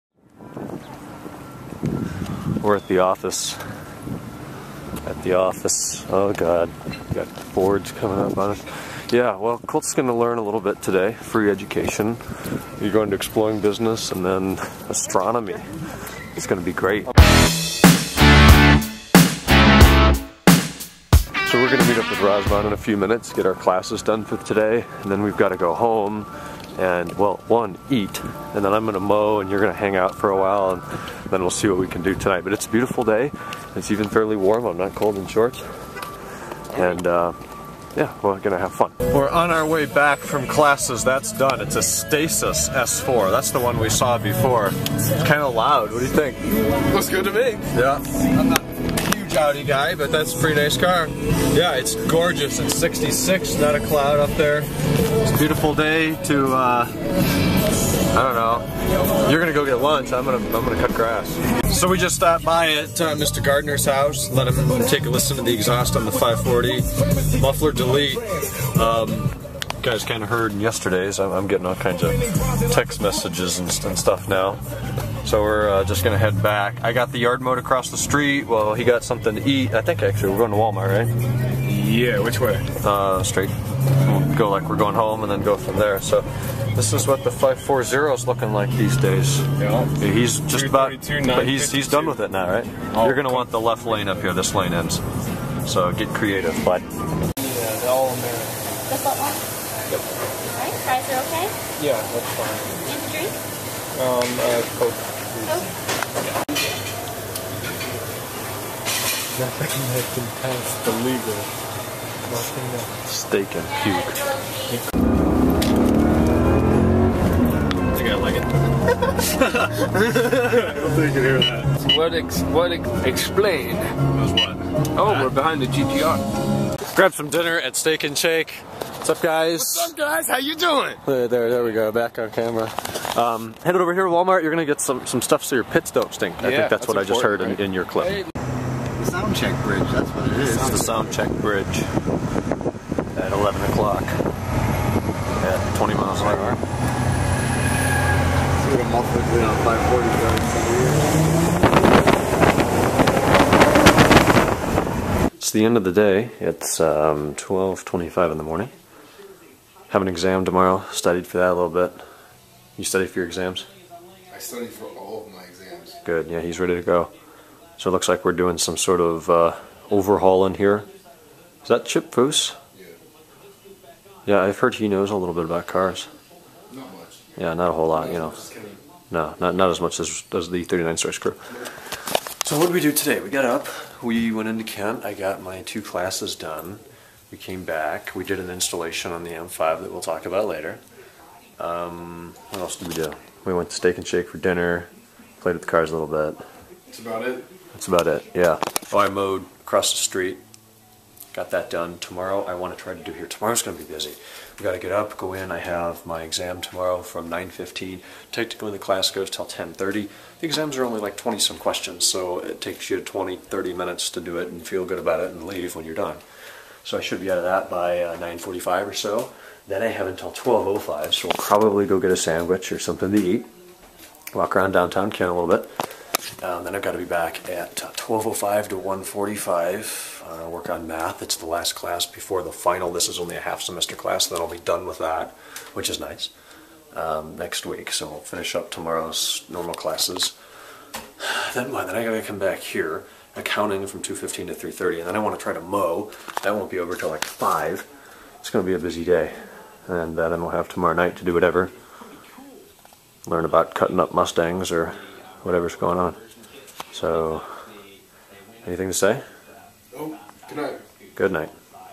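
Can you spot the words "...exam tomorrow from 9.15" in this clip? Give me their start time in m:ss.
3:26.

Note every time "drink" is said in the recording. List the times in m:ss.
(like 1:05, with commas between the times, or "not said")
1:43.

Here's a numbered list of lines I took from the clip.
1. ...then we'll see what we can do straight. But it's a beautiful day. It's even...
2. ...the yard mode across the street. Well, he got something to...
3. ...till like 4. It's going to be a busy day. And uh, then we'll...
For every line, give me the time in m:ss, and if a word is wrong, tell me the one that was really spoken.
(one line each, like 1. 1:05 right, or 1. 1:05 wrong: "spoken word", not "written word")
1. 0:31 wrong: "tonight", not "straight"
2. 1:17 right
3. 4:06 wrong: "5", not "4".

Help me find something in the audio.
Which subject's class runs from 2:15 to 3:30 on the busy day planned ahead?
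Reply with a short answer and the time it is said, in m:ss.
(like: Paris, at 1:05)
Accounting, at 4:03.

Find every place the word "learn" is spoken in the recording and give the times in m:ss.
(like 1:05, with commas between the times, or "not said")
0:10, 4:13.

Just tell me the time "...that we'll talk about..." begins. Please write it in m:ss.
3:09.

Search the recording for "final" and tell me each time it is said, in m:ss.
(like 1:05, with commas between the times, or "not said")
3:52.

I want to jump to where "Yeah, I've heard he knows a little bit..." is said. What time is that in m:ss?
2:54.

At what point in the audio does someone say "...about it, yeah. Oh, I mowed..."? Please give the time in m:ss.
3:17.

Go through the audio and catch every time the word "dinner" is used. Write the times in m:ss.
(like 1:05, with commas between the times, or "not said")
2:07, 3:14.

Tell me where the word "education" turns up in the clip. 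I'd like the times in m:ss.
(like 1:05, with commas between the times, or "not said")
0:11.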